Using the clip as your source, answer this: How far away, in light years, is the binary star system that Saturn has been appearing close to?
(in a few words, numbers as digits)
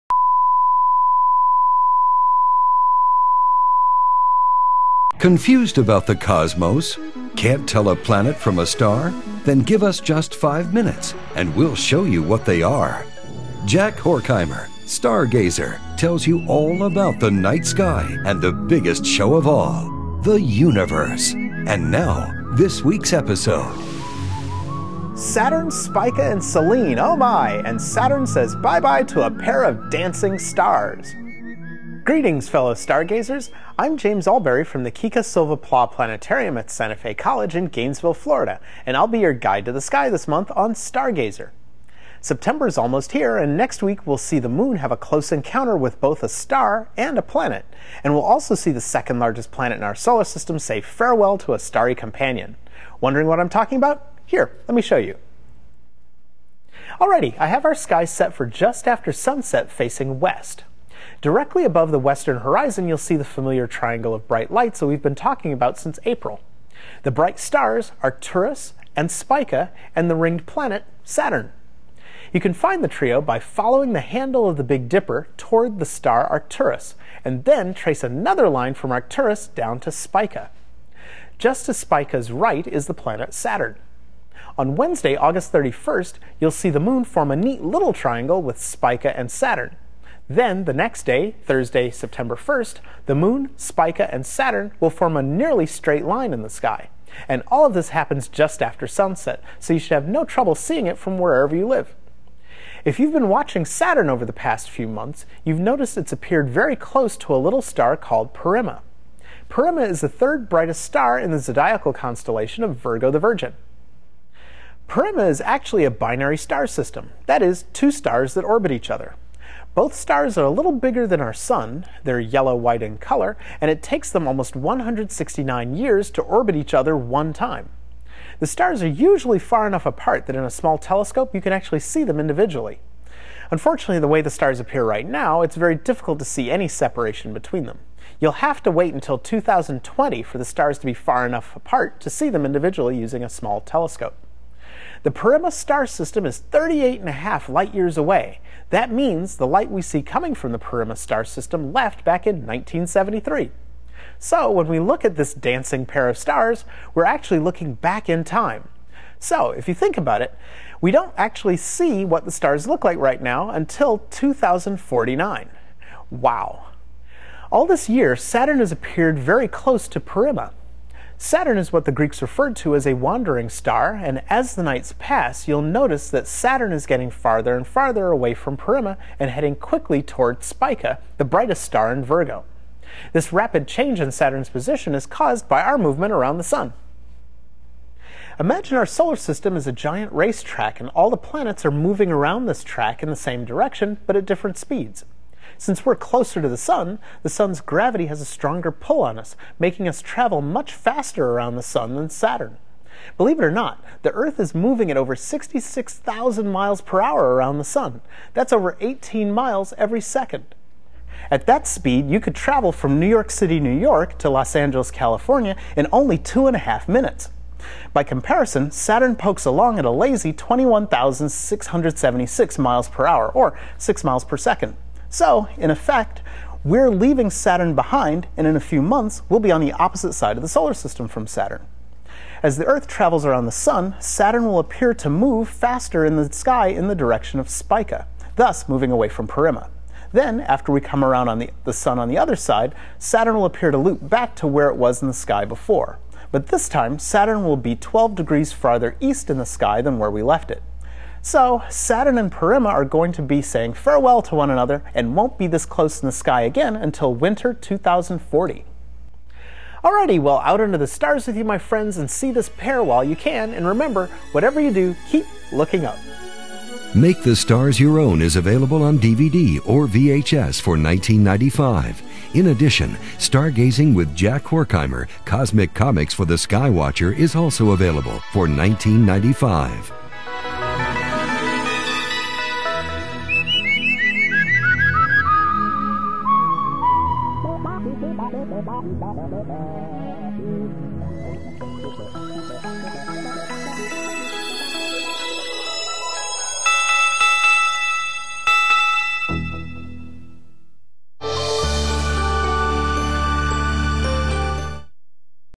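38 and a half.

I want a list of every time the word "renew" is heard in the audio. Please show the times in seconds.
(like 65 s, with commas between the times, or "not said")
not said.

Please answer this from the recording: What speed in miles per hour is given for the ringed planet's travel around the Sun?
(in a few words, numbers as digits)
21,676.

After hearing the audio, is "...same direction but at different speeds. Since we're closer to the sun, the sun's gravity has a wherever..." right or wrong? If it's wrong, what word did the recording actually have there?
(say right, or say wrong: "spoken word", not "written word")
wrong: "stronger", not "wherever".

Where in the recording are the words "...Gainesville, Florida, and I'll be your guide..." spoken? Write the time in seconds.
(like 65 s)
37 s.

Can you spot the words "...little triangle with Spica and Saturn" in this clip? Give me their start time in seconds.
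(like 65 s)
87 s.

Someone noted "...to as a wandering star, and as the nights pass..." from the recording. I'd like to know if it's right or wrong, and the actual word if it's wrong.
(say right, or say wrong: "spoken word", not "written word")
right.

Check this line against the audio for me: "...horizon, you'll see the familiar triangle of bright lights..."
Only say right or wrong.
right.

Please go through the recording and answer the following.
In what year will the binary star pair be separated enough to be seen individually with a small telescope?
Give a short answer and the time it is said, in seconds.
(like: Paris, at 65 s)
2020, at 139 s.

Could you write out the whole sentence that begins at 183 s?
This rapid change in Saturn's position is caused by our movement around the Sun.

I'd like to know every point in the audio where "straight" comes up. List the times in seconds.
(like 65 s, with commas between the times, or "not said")
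95 s.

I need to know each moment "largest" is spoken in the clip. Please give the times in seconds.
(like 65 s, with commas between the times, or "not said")
49 s.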